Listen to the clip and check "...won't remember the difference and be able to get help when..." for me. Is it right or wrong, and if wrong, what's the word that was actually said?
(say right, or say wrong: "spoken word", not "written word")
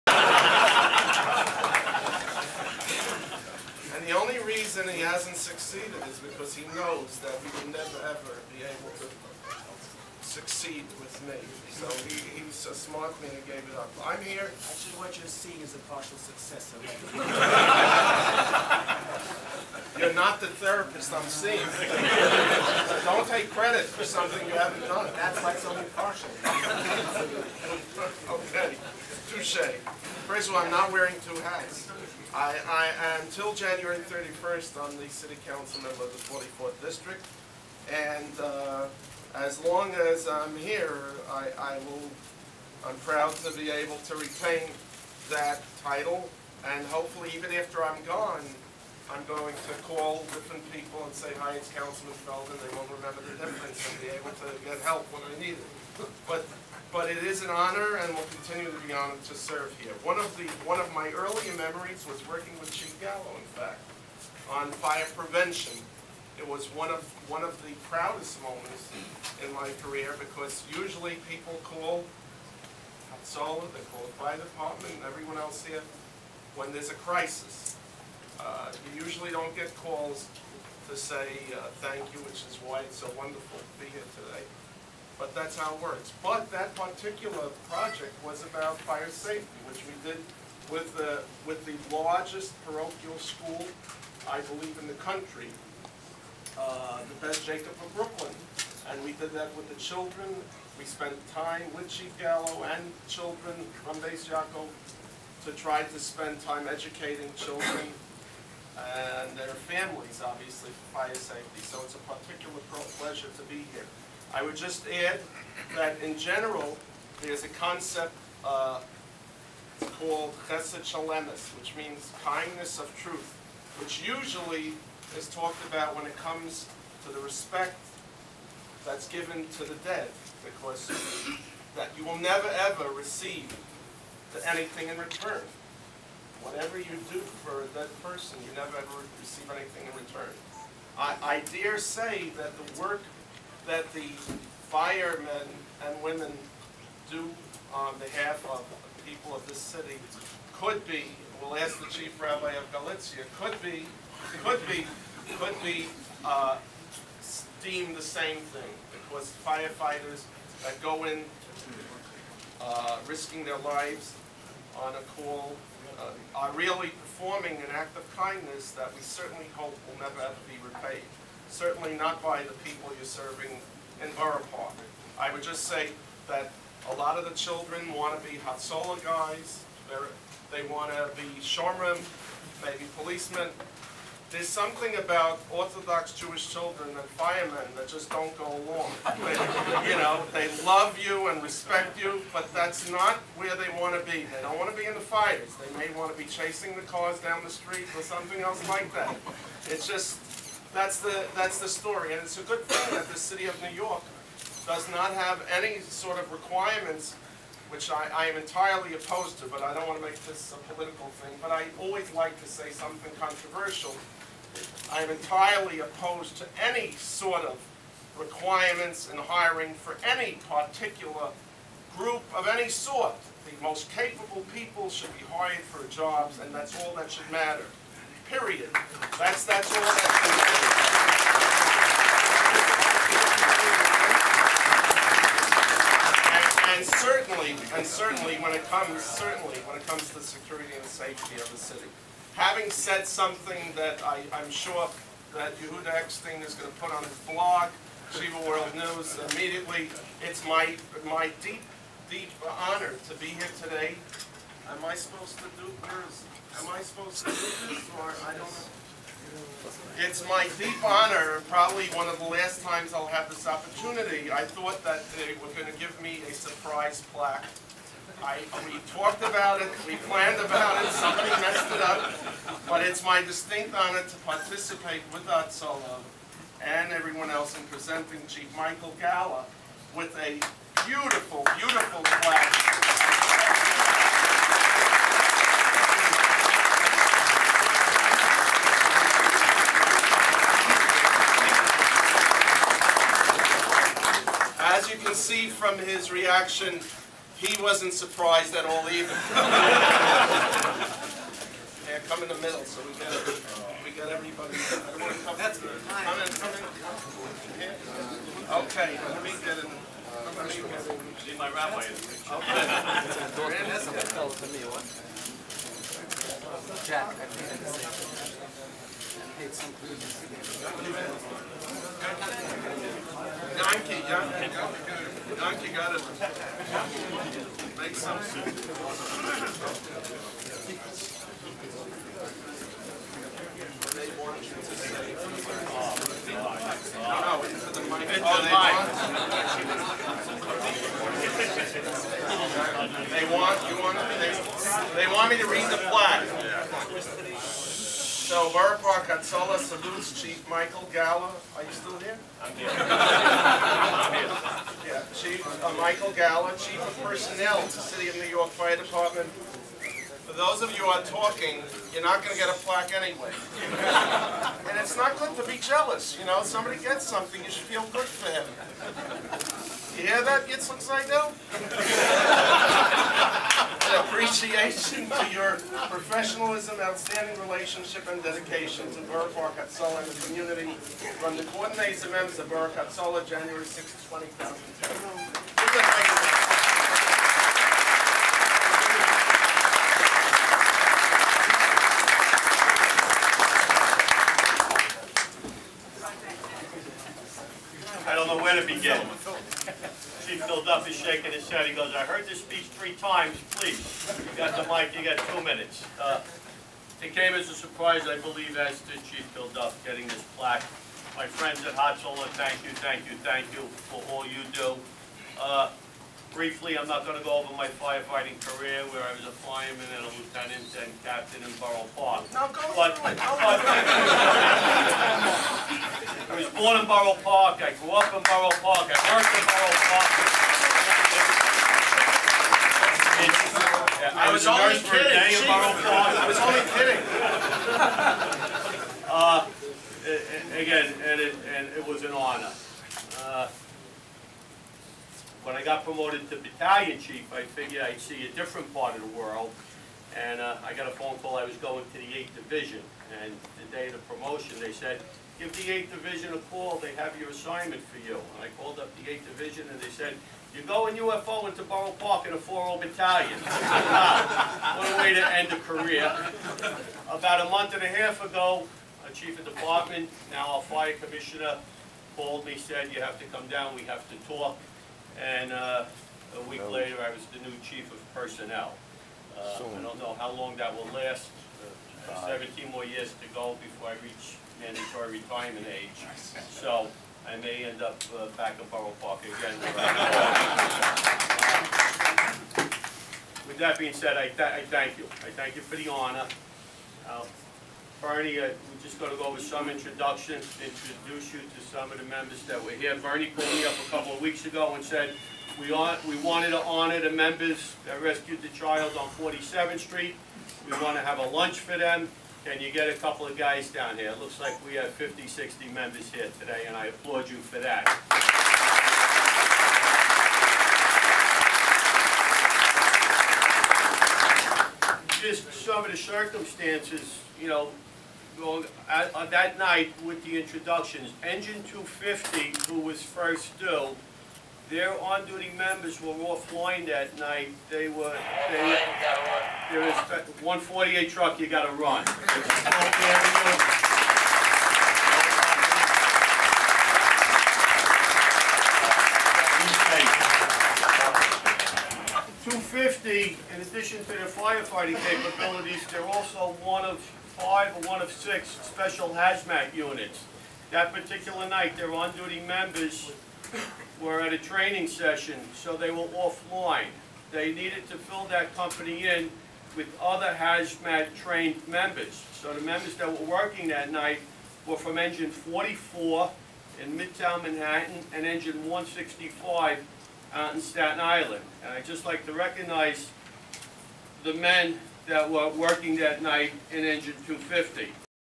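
right.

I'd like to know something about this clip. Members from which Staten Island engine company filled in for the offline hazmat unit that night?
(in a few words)
Engine 165.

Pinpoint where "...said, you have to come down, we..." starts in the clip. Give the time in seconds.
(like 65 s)
472 s.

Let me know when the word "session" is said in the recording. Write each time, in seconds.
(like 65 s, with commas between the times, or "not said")
564 s.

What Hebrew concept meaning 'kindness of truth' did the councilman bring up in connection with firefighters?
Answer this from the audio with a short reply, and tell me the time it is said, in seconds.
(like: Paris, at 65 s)
chesed shel emes, at 120 s.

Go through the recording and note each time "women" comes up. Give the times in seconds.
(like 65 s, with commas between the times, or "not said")
146 s.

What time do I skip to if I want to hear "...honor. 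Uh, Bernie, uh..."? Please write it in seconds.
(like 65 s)
495 s.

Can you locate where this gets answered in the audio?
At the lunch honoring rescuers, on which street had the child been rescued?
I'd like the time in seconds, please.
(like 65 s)
509 s.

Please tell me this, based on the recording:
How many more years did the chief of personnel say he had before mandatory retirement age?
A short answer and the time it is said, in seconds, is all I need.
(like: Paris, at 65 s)
17, at 482 s.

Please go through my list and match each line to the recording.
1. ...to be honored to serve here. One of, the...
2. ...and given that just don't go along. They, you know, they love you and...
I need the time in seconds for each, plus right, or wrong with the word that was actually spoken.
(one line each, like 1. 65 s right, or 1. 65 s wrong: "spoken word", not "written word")
1. 58 s right
2. 186 s wrong: "firemen", not "given".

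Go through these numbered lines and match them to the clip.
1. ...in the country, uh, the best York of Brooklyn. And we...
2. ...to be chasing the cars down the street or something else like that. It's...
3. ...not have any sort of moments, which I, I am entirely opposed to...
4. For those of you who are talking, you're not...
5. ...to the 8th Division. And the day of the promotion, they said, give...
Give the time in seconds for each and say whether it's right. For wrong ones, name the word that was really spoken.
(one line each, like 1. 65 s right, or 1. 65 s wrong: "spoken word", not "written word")
1. 94 s wrong: "Jacob", not "York"
2. 196 s right
3. 204 s wrong: "requirements", not "moments"
4. 360 s right
5. 451 s right.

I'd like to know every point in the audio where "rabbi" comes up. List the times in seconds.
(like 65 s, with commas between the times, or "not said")
152 s, 311 s.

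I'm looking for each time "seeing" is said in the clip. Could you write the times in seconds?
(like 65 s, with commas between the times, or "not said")
15 s, 21 s.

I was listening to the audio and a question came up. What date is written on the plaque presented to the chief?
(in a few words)
January 6, 2010.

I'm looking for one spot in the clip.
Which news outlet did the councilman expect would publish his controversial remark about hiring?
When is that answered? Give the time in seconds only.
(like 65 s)
248 s.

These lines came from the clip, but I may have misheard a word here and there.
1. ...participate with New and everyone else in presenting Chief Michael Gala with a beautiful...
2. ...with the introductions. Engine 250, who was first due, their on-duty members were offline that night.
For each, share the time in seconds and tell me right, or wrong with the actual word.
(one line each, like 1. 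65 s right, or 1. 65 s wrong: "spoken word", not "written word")
1. 274 s wrong: "Hatzolah", not "New"
2. 530 s right.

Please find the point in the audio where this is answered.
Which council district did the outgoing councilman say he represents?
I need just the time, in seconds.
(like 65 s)
36 s.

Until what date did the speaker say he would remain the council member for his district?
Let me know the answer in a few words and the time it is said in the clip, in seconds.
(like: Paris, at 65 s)
January 31st, at 33 s.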